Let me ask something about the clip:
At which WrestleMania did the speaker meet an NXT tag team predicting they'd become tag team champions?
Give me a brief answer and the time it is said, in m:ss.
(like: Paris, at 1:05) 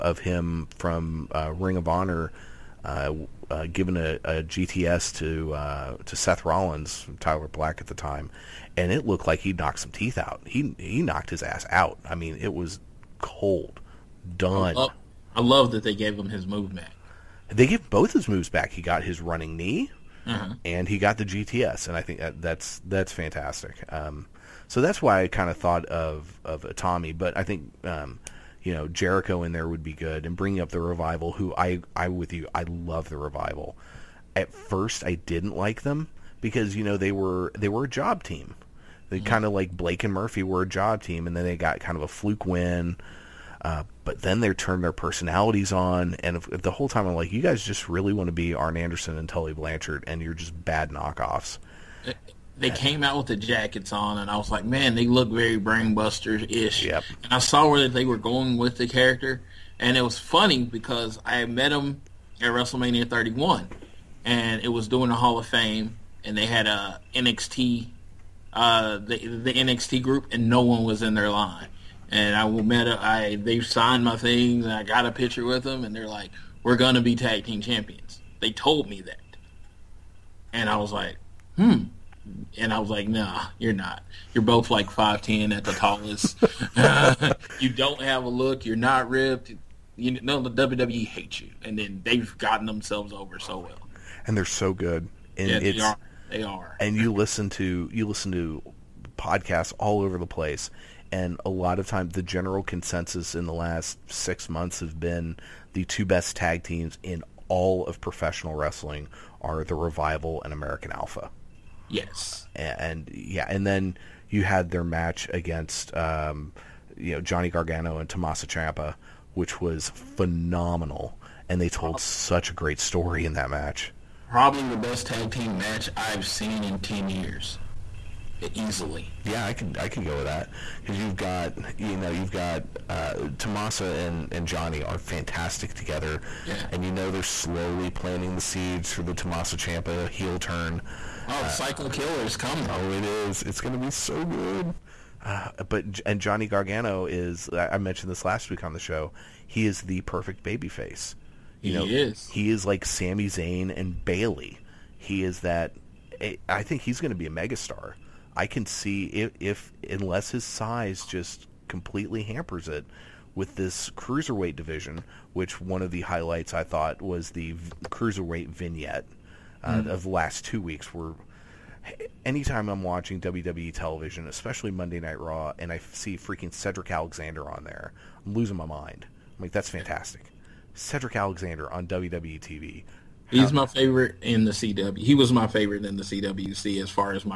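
WrestleMania 31, at 1:02.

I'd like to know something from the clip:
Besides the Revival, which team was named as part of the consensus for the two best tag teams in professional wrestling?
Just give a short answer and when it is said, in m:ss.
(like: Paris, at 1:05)
American Alpha, at 1:50.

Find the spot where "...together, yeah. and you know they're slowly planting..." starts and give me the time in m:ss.
2:15.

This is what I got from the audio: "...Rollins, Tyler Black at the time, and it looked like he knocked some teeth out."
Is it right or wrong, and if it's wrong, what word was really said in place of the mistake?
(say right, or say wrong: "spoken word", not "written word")
right.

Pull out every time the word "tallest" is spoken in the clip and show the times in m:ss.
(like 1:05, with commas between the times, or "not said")
1:25.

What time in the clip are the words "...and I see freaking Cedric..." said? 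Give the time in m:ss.
2:55.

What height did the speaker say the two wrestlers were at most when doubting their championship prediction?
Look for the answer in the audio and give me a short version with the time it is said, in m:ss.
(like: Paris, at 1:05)
5'10, at 1:24.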